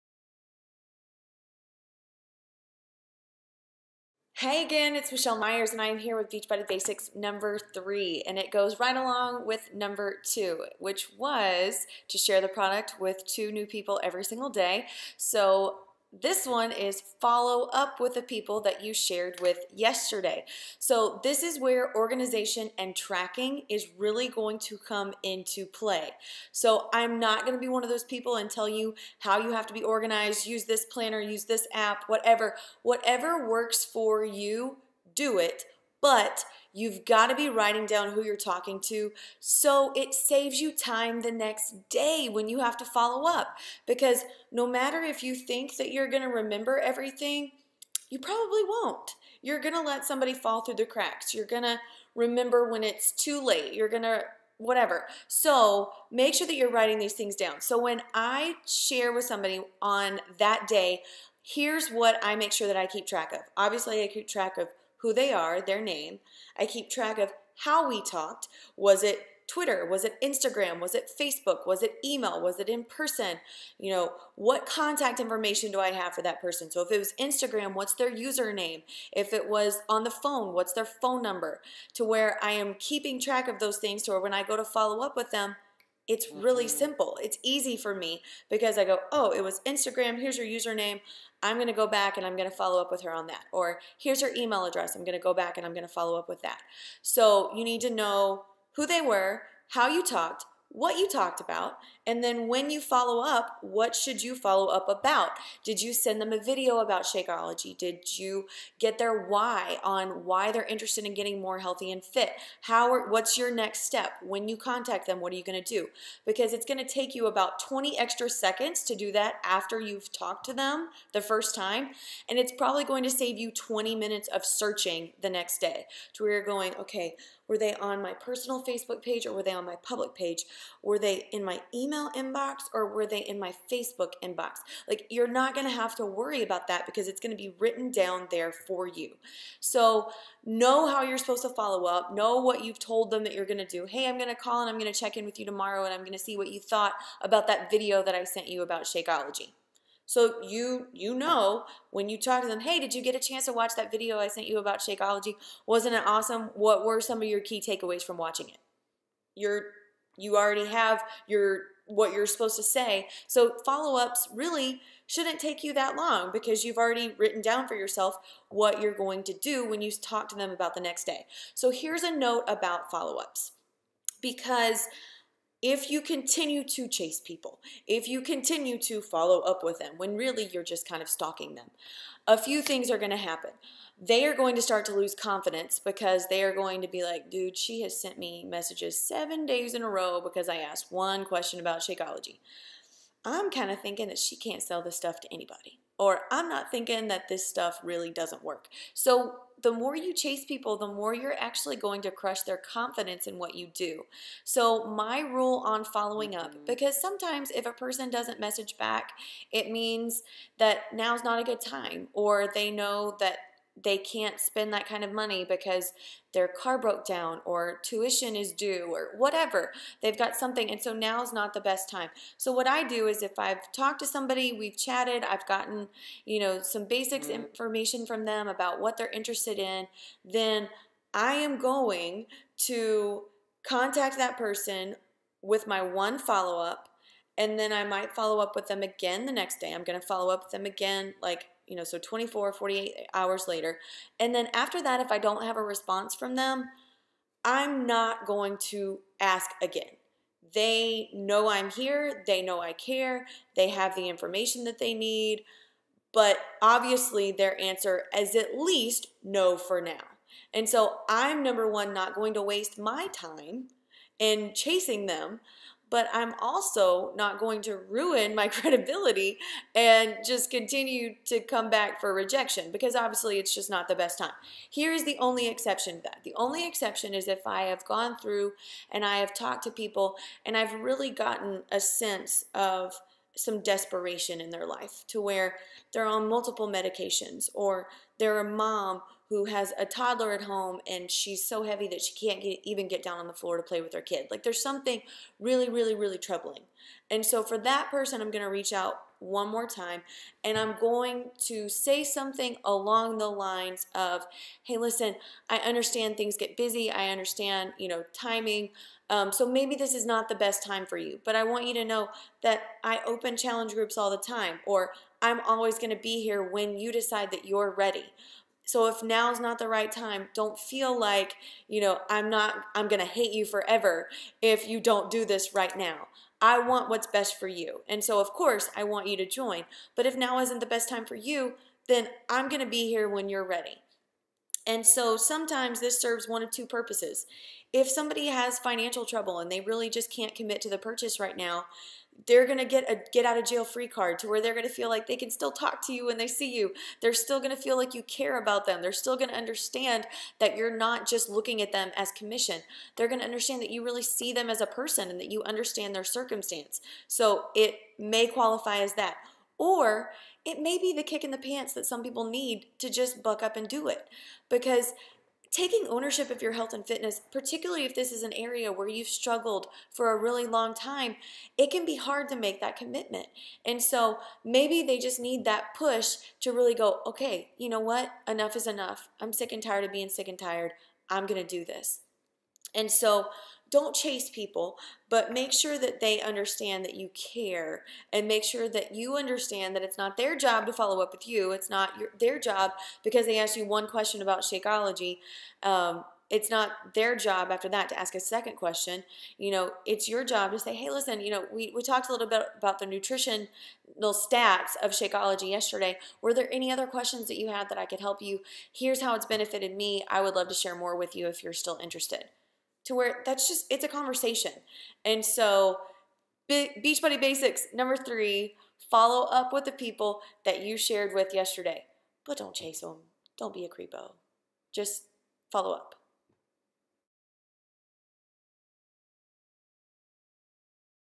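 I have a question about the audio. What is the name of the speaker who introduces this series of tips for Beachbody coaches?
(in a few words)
Michelle Myers.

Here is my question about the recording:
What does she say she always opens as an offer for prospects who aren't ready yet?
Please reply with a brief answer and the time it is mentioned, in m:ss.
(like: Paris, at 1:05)
challenge groups, at 5:13.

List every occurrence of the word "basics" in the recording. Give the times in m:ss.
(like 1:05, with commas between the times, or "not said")
0:06, 3:46, 6:57.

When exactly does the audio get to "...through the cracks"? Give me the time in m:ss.
0:50.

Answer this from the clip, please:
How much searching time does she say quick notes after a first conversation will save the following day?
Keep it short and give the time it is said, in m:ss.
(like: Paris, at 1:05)
20 minutes, at 2:03.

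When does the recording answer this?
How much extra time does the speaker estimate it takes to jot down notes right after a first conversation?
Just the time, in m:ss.
1:57.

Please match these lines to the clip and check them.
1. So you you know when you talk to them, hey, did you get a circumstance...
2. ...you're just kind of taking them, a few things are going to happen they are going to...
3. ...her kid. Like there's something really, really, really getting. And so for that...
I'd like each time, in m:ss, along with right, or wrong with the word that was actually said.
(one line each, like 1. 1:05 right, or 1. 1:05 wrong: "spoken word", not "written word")
1. 2:30 wrong: "chance", not "circumstance"
2. 3:00 wrong: "stalking", not "taking"
3. 4:53 wrong: "troubling", not "getting".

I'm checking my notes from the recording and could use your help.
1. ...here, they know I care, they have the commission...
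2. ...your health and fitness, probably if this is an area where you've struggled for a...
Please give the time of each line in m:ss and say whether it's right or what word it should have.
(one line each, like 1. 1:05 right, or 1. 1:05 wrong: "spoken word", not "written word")
1. 4:11 wrong: "information", not "commission"
2. 6:06 wrong: "particularly", not "probably".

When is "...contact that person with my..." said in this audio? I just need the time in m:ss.
3:53.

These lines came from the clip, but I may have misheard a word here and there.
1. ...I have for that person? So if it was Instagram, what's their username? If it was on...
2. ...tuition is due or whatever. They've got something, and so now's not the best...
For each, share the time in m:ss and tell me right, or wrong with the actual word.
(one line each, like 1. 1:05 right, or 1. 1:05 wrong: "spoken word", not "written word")
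1. 1:15 right
2. 3:37 right.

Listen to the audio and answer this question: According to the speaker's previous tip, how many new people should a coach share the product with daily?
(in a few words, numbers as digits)
2.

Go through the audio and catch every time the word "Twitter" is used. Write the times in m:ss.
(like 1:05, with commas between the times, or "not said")
1:09.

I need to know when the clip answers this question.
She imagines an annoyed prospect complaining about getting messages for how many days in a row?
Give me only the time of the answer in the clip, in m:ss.
3:08.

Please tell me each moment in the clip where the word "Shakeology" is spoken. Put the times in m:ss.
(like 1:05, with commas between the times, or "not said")
1:47, 2:28, 2:34, 3:11, 6:34, 6:44.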